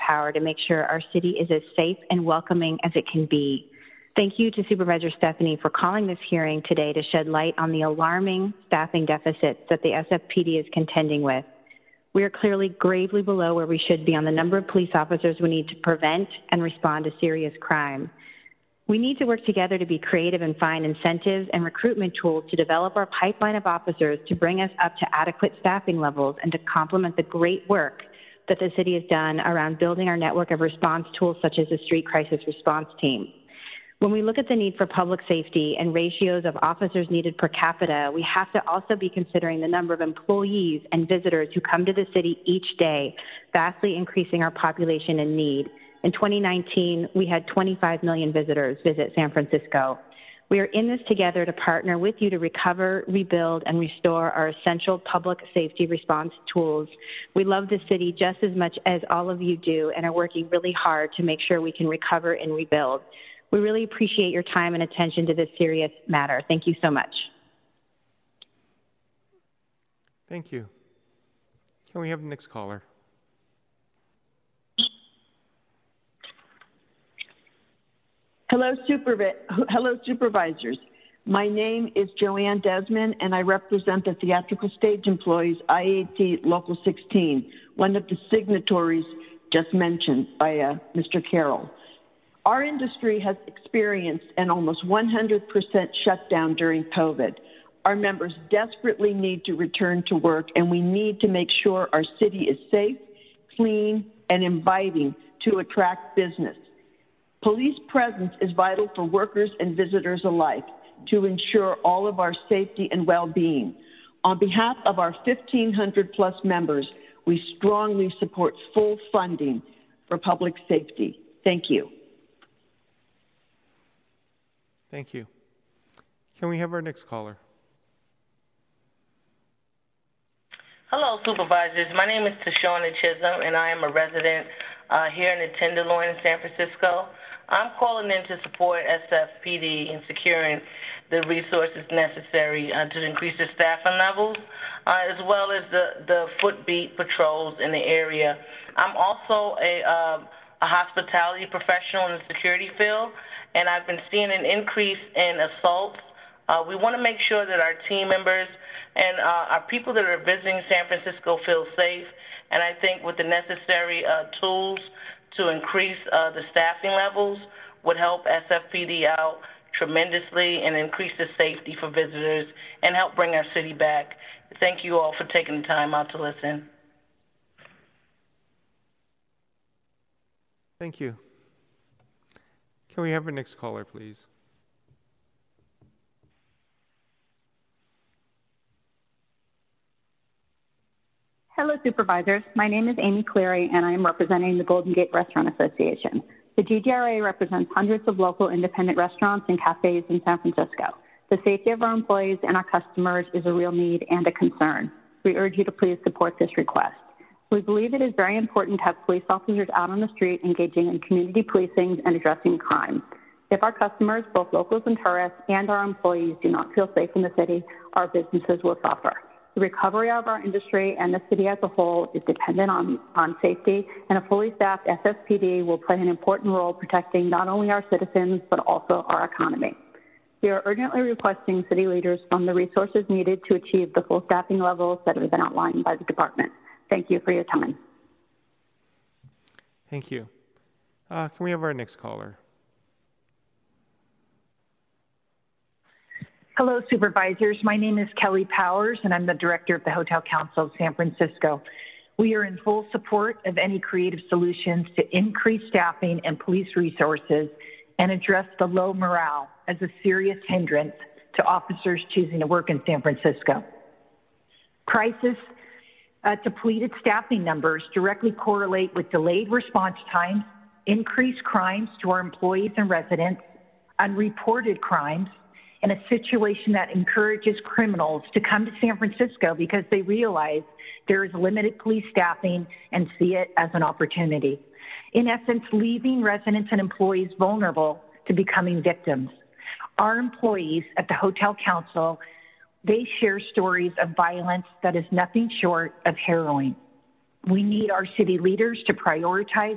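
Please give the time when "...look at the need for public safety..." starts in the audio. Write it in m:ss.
0:34.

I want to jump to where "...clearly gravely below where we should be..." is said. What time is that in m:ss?
0:12.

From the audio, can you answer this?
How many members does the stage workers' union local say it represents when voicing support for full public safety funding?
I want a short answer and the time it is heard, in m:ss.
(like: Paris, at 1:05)
1,500, at 1:55.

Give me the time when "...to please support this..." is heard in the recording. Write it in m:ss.
3:25.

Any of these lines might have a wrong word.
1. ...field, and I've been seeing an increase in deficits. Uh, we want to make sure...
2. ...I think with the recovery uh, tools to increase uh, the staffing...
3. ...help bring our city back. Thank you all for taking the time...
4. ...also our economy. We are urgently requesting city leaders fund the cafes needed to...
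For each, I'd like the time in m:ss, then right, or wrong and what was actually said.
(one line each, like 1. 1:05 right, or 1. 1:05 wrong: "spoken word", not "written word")
1. 2:32 wrong: "assaults", not "deficits"
2. 2:42 wrong: "necessary", not "recovery"
3. 2:52 right
4. 3:48 wrong: "resources", not "cafes".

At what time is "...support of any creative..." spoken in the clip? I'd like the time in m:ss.
4:12.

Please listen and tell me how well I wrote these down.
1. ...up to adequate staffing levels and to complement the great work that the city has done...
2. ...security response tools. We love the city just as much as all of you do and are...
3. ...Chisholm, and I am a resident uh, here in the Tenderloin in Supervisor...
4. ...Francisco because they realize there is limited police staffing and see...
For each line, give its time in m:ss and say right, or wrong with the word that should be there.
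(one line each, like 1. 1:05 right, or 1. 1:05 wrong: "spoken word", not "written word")
1. 0:24 right
2. 0:55 wrong: "safety", not "security"
3. 2:12 wrong: "San", not "Supervisor"
4. 4:38 right.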